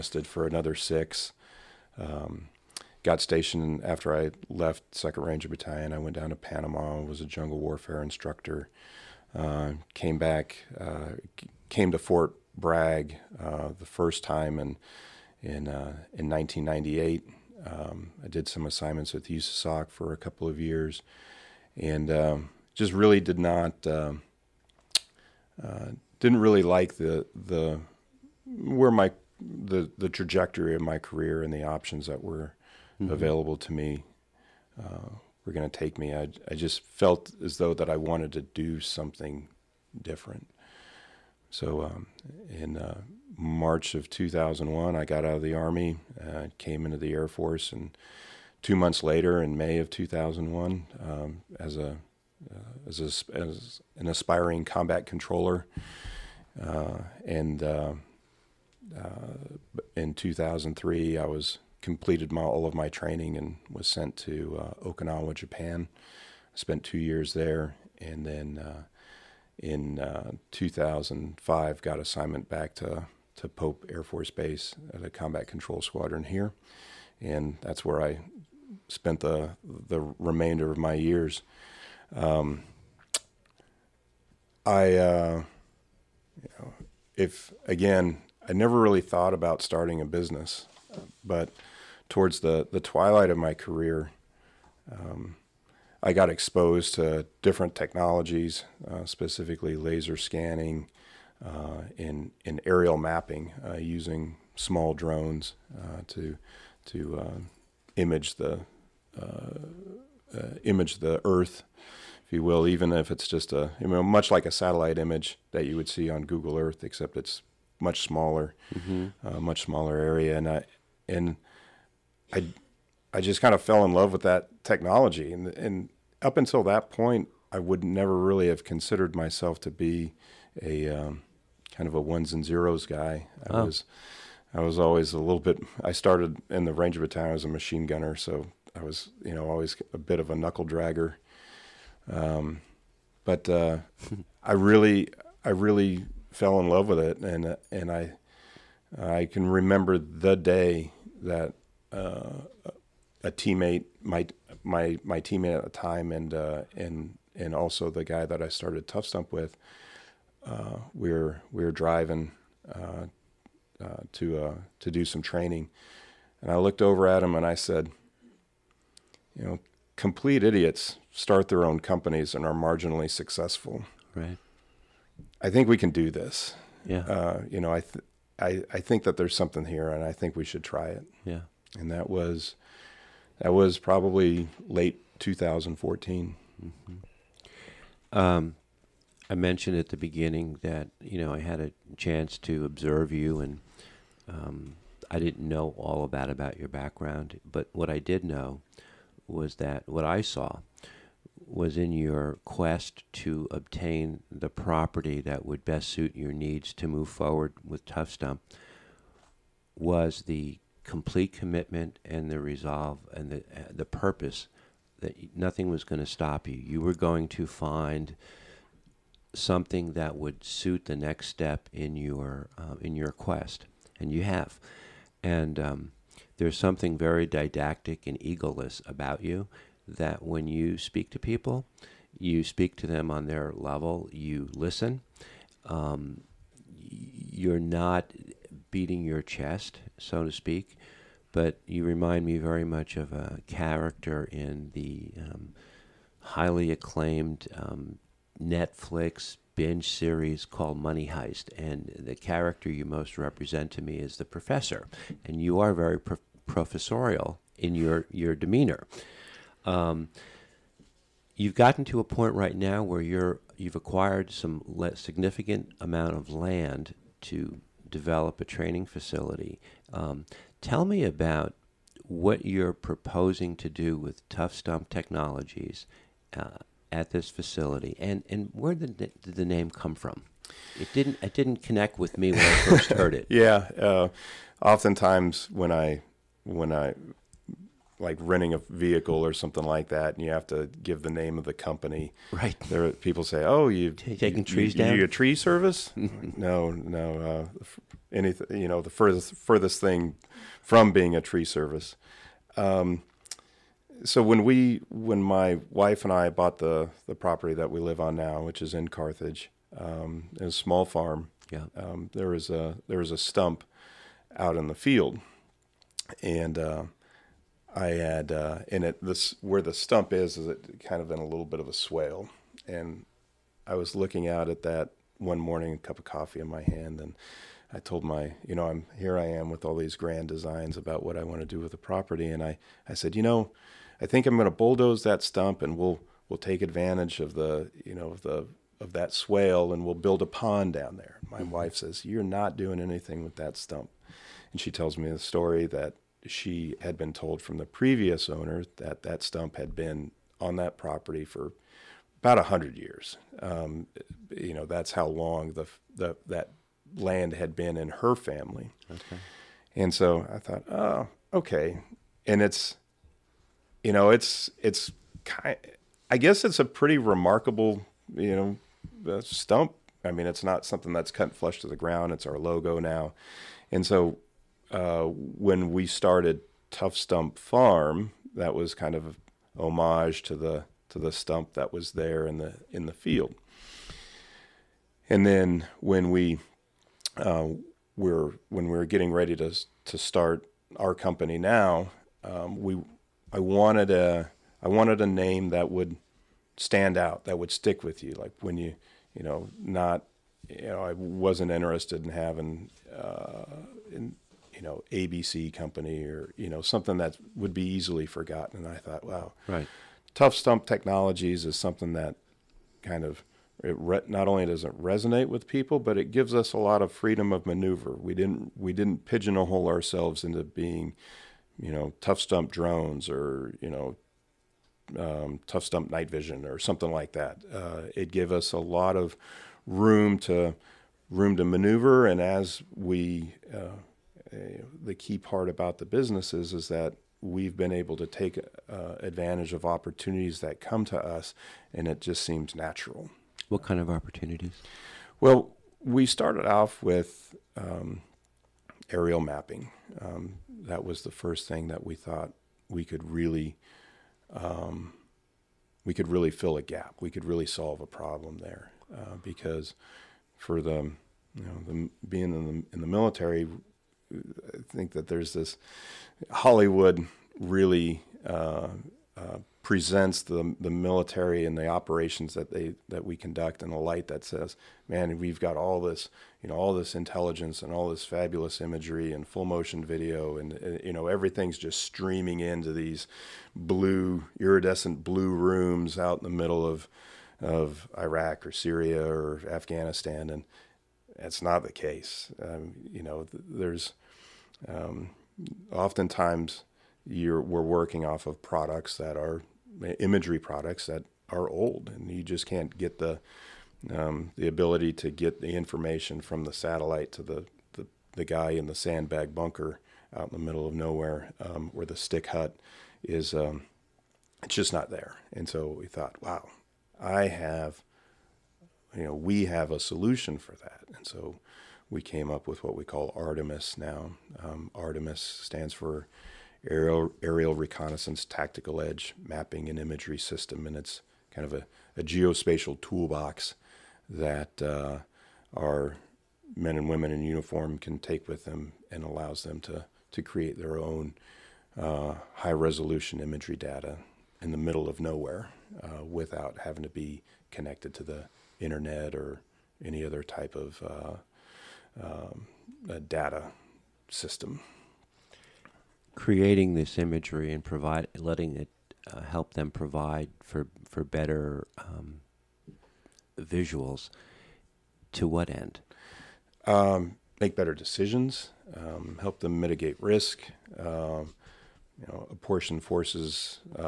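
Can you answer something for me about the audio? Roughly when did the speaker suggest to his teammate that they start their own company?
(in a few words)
Late 2014.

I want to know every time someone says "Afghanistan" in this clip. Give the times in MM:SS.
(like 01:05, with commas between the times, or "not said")
08:09.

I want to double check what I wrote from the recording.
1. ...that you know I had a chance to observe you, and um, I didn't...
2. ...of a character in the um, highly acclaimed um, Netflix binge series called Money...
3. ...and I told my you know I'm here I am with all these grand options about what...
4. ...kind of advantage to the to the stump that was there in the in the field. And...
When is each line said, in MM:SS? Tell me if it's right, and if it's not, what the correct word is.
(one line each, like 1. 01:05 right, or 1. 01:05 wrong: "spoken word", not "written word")
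1. 03:10 right
2. 04:02 right
3. 05:26 wrong: "designs", not "options"
4. 06:18 wrong: "homage", not "advantage".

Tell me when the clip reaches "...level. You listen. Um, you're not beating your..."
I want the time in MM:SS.
03:53.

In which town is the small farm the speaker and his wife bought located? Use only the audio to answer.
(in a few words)
Carthage.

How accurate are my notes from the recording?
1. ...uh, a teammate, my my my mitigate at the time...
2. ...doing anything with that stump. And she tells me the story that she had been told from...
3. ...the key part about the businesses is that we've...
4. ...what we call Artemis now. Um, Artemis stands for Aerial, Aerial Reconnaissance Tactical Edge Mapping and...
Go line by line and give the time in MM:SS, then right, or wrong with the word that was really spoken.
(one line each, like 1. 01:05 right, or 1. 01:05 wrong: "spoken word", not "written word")
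1. 02:31 wrong: "teammate", not "mitigate"
2. 05:42 right
3. 07:14 right
4. 08:42 right.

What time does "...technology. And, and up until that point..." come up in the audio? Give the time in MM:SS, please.
02:04.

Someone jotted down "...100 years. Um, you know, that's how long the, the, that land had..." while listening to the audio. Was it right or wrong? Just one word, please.
right.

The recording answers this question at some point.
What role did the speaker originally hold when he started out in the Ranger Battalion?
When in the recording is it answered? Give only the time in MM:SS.
02:17.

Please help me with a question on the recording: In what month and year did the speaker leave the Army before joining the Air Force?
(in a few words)
March 2001.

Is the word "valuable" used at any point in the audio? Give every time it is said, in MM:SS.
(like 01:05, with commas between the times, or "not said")
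not said.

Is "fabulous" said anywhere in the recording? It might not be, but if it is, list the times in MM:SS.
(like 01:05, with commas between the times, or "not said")
07:58.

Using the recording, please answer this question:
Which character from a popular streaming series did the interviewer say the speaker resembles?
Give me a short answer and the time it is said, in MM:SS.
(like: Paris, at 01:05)
The professor, at 04:14.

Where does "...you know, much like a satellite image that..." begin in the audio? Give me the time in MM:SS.
01:53.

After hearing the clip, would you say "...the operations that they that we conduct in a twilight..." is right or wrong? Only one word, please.
wrong.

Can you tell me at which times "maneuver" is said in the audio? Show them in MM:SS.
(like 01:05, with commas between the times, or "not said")
06:57, 07:11.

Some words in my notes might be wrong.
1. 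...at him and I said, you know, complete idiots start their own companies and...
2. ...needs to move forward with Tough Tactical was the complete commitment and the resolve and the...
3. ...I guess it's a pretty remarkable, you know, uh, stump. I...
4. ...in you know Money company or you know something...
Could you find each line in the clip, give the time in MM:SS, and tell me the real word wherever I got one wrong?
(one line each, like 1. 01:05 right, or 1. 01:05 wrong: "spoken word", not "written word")
1. 02:47 right
2. 03:26 wrong: "Stump", not "Tactical"
3. 06:06 right
4. 06:43 wrong: "ABC", not "Money".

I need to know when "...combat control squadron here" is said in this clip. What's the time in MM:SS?
01:15.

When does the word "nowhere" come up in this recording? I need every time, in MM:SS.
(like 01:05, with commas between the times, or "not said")
08:30, 09:05.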